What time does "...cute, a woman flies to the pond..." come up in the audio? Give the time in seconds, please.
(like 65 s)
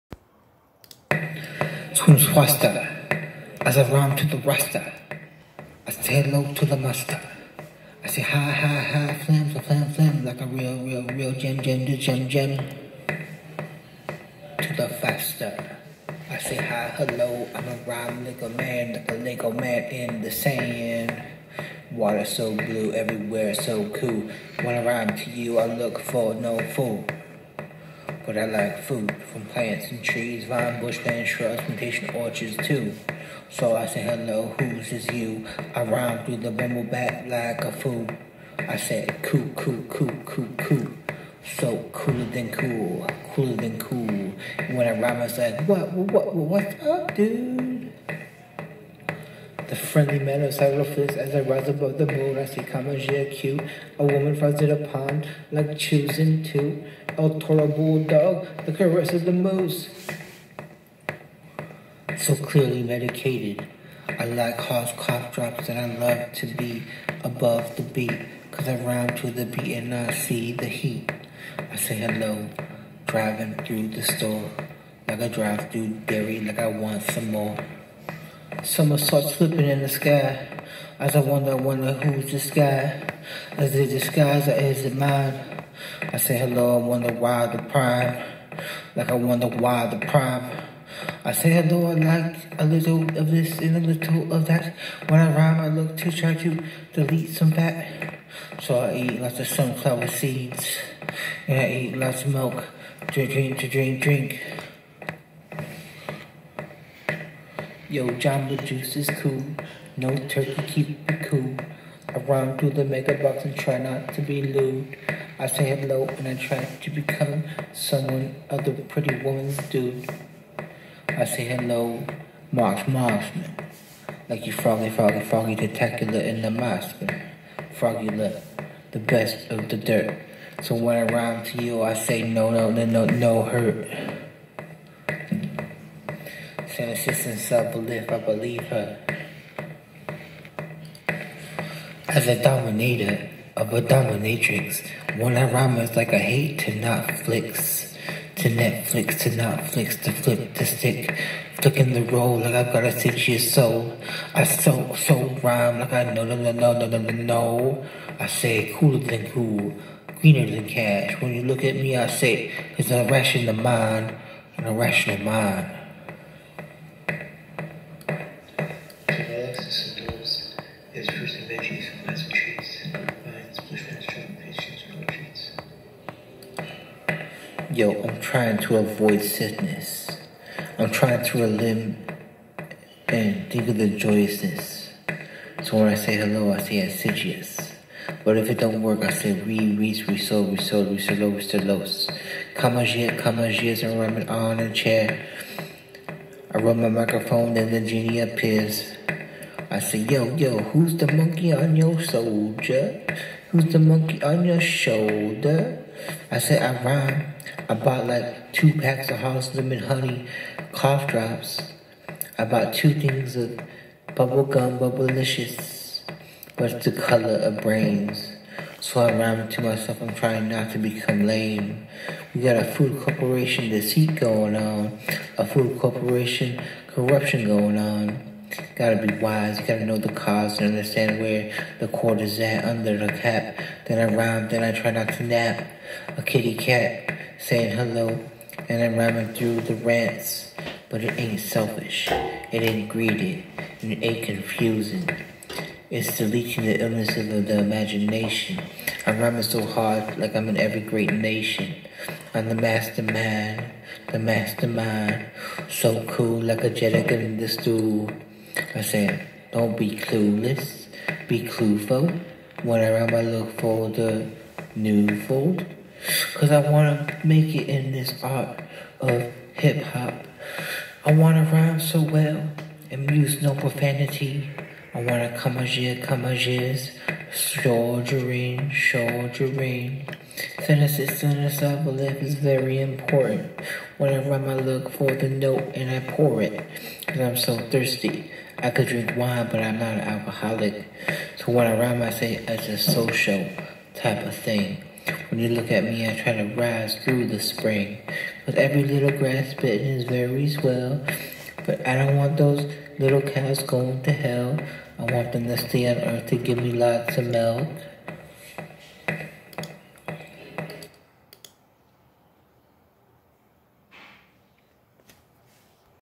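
53 s.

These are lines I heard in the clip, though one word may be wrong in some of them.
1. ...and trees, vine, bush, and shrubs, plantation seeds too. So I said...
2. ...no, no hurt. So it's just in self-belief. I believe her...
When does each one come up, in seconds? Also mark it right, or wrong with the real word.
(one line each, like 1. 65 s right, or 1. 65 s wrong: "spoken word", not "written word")
1. 29 s wrong: "orchards", not "seeds"
2. 132 s right.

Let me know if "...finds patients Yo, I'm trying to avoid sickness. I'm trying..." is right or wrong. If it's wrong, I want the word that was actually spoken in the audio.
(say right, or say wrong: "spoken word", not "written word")
right.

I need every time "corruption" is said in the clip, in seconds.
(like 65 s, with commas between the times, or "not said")
226 s.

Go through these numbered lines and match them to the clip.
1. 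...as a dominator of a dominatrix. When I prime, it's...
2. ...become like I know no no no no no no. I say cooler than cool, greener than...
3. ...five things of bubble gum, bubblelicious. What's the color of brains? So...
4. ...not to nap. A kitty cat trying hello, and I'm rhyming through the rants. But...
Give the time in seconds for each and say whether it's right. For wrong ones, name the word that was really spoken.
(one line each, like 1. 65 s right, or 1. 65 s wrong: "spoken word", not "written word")
1. 142 s wrong: "rhyme", not "prime"
2. 155 s wrong: "rhyme", not "become"
3. 212 s wrong: "two", not "five"
4. 234 s wrong: "saying", not "trying".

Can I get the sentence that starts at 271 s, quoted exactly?
I wanna rhyme so well and use no profanity.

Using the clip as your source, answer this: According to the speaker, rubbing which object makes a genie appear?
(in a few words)
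Microphone.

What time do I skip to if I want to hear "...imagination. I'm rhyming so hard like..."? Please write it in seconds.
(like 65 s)
247 s.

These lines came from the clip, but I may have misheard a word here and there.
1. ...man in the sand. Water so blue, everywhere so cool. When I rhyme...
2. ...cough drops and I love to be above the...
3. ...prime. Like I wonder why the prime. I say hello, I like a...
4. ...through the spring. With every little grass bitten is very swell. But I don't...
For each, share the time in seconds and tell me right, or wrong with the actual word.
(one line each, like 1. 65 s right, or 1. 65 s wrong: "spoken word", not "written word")
1. 19 s right
2. 64 s right
3. 87 s right
4. 297 s right.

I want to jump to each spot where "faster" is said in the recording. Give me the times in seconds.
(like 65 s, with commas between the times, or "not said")
2 s, 14 s.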